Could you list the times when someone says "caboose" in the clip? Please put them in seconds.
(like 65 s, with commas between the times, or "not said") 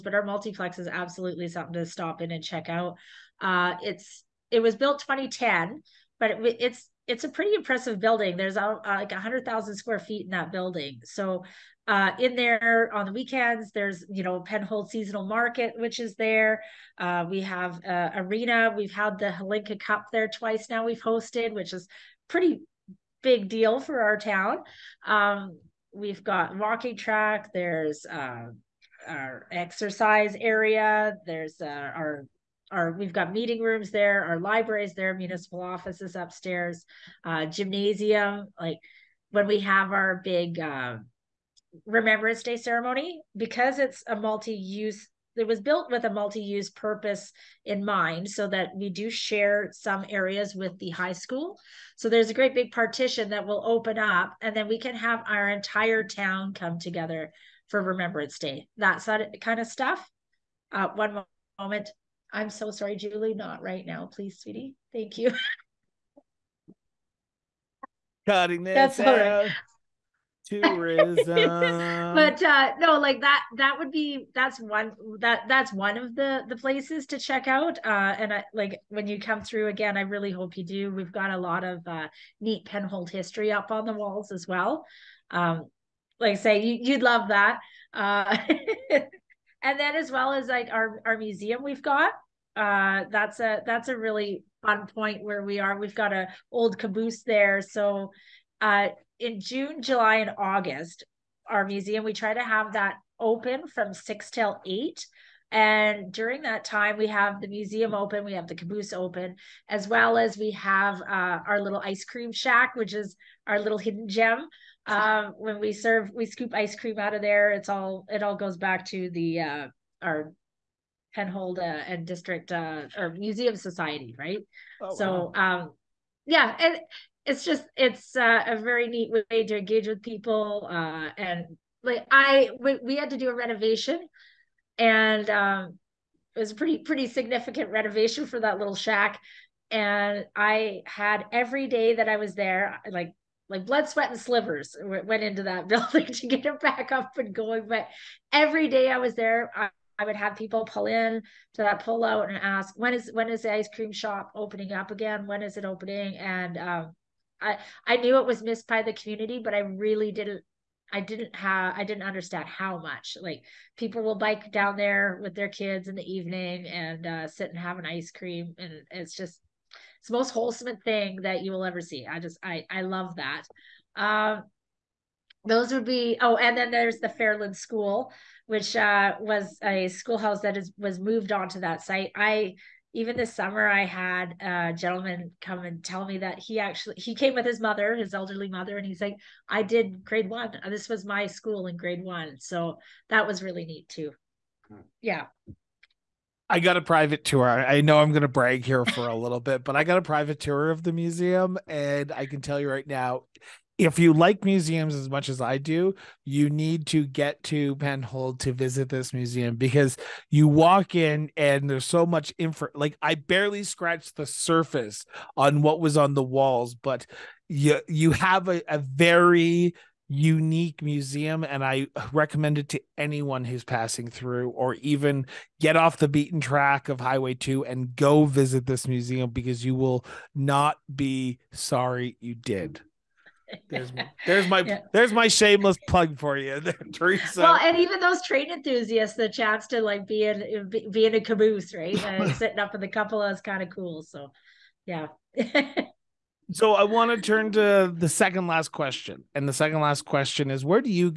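96 s, 108 s, 241 s.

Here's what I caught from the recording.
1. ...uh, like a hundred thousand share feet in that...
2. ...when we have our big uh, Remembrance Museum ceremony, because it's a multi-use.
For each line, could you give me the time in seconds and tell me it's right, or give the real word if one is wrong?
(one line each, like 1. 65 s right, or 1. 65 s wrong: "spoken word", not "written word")
1. 8 s wrong: "square", not "share"
2. 39 s wrong: "Day", not "Museum".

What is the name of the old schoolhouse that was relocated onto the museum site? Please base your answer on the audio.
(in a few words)
Fairland School.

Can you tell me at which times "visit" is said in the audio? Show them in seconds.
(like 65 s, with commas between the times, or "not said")
208 s, 228 s.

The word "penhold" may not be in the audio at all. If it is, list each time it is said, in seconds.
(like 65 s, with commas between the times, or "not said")
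14 s, 82 s, 121 s, 207 s.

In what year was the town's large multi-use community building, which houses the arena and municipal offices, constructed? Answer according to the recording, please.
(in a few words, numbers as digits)
2010.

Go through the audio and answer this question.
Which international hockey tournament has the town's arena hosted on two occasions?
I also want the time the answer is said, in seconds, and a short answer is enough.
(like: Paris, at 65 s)
Hlinka Cup, at 19 s.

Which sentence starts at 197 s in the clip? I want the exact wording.
I know I'm going to brag here for a little bit, but I got a private tour of the museum.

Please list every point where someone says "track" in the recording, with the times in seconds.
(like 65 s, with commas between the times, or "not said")
26 s, 226 s.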